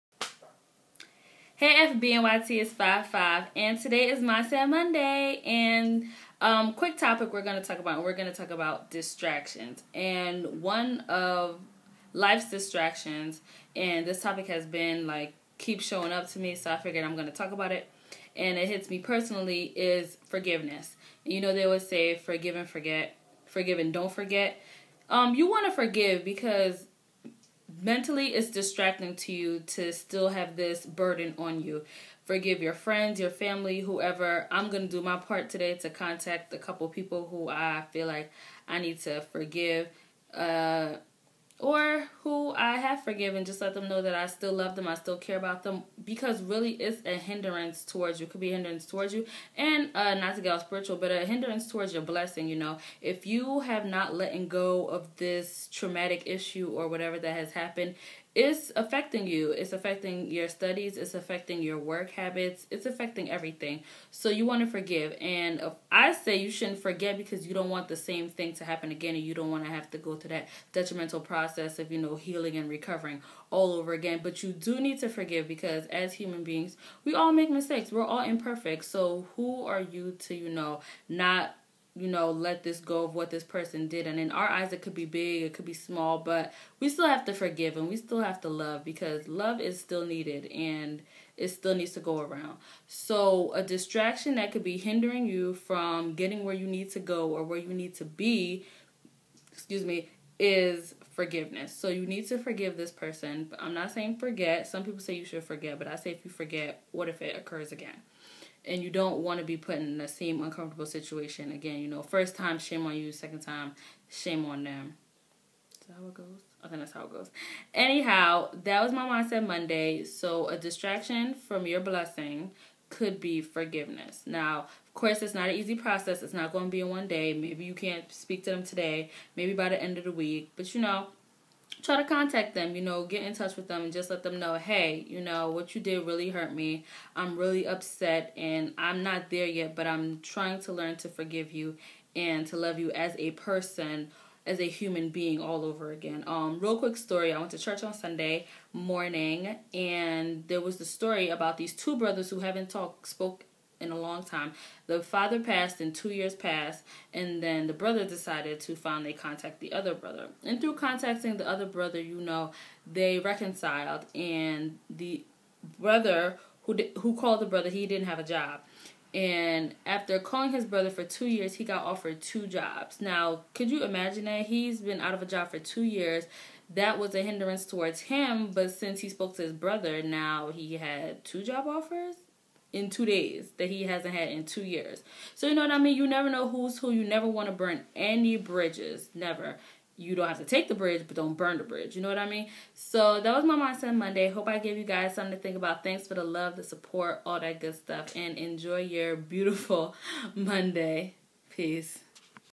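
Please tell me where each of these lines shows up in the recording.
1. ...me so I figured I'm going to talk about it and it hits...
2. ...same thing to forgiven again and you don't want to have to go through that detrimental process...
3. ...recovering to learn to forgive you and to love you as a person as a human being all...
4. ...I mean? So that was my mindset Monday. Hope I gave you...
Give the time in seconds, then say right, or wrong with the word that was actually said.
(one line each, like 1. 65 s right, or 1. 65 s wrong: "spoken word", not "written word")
1. 16 s right
2. 67 s wrong: "happen", not "forgiven"
3. 140 s wrong: "trying", not "recovering"
4. 192 s right.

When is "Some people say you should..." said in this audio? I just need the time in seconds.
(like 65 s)
104 s.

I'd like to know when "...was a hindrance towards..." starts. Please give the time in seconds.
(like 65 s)
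176 s.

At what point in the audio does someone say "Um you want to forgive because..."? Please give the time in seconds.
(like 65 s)
25 s.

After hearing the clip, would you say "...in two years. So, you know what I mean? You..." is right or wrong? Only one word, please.
right.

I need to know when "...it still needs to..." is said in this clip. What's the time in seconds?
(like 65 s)
91 s.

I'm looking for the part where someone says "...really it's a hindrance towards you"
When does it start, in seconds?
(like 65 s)
46 s.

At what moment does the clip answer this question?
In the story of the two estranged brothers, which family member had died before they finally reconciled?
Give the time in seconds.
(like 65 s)
154 s.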